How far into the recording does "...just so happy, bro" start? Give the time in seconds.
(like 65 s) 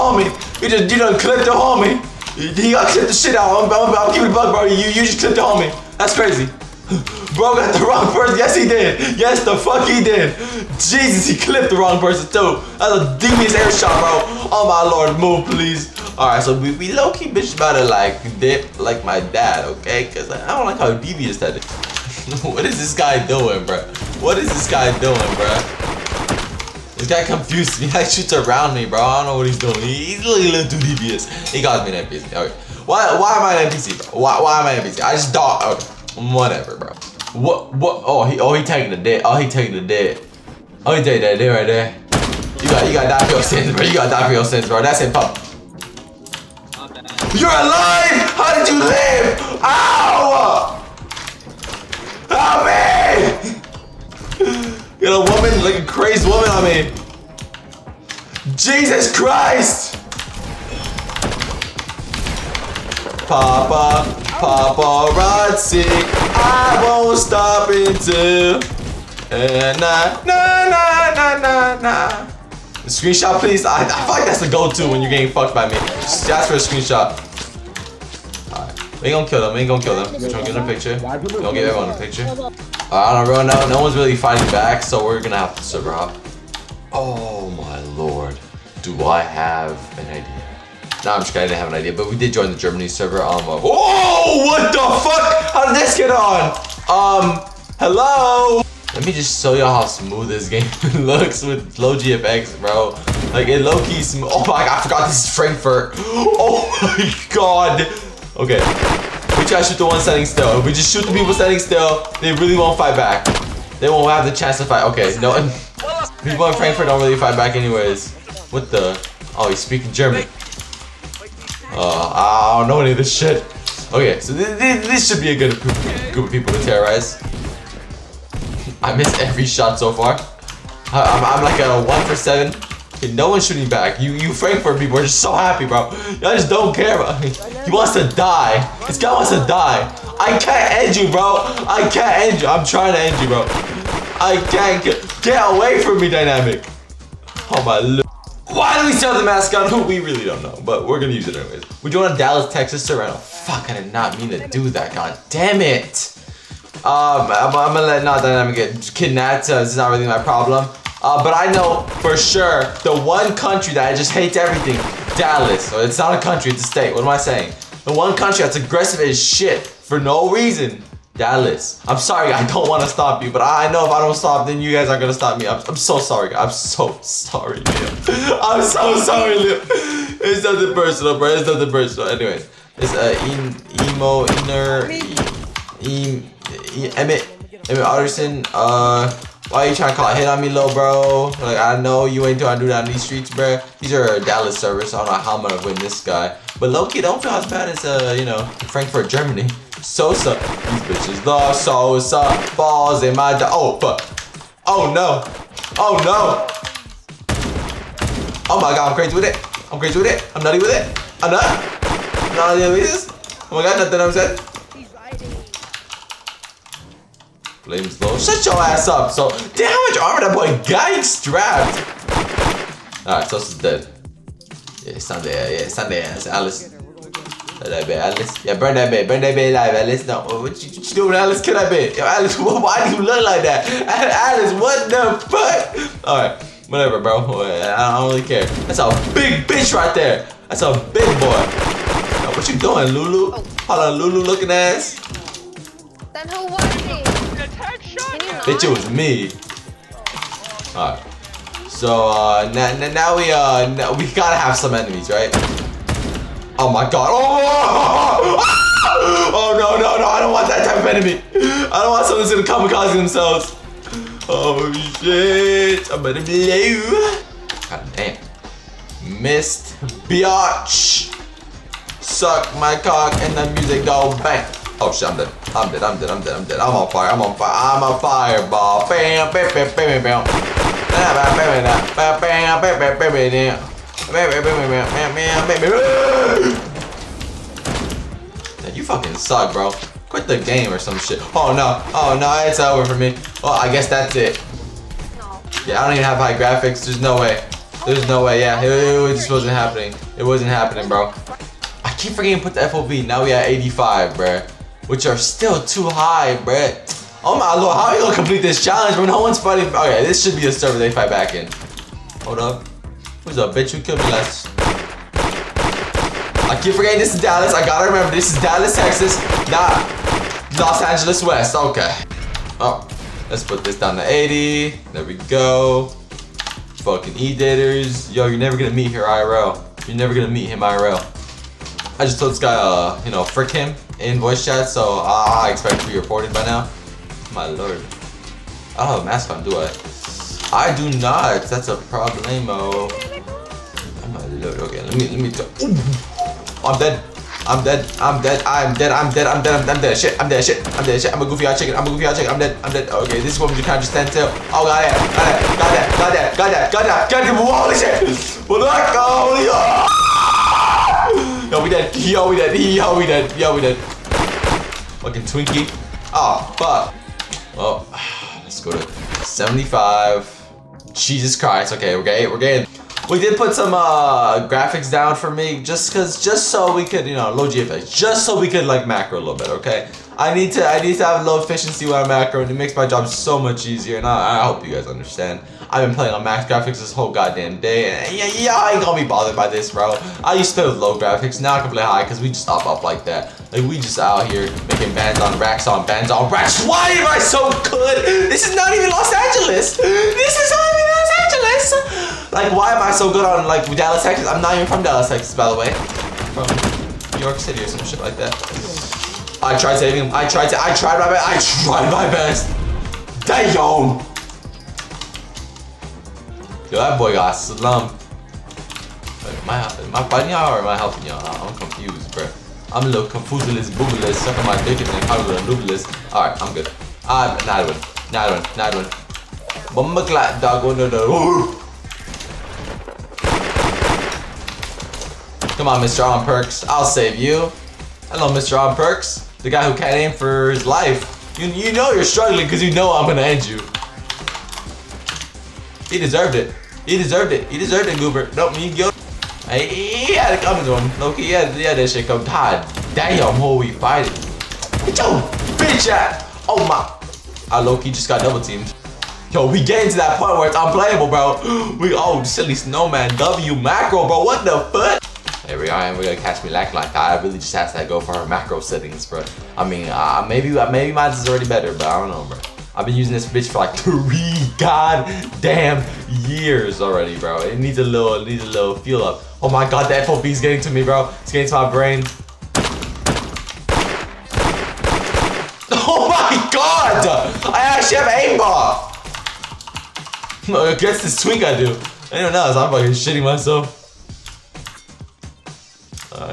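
135 s.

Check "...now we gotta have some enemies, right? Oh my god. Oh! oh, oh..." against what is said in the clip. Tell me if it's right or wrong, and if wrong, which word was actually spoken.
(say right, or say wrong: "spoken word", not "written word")
right.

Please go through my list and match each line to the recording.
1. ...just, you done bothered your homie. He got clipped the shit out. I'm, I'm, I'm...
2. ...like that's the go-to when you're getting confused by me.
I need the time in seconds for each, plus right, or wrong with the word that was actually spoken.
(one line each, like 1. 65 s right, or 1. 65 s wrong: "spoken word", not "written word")
1. 0 s wrong: "clipped", not "bothered"
2. 74 s wrong: "fucked", not "confused".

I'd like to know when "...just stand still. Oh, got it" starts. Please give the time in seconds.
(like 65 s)
353 s.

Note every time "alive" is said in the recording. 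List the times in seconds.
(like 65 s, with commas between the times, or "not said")
47 s, 229 s.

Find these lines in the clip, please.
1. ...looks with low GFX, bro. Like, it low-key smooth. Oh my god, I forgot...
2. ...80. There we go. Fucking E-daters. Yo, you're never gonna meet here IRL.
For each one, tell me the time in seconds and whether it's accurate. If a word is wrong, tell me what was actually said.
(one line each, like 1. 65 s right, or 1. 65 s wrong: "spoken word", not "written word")
1. 101 s right
2. 324 s right.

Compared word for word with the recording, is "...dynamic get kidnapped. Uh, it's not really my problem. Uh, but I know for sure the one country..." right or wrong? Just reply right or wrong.
right.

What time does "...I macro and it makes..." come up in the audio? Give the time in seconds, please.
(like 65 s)
381 s.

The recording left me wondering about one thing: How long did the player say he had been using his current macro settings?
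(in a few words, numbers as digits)
3 years.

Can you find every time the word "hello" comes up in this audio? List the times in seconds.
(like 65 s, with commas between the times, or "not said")
97 s, 438 s.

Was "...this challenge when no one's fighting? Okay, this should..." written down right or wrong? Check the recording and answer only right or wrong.
right.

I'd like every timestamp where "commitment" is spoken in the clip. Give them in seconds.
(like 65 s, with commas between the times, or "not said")
not said.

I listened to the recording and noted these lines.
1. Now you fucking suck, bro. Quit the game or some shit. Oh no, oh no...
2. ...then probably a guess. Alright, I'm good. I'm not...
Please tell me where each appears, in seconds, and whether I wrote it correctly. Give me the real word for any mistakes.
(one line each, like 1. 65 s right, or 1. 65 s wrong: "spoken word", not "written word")
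1. 288 s right
2. 424 s wrong: "noobless", not "guess".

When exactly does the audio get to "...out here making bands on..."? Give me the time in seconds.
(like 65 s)
393 s.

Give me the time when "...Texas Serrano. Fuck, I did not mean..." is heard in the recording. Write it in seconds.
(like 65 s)
152 s.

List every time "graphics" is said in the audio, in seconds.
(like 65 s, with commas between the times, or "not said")
296 s, 374 s, 386 s, 390 s.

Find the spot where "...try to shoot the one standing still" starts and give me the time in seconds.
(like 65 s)
109 s.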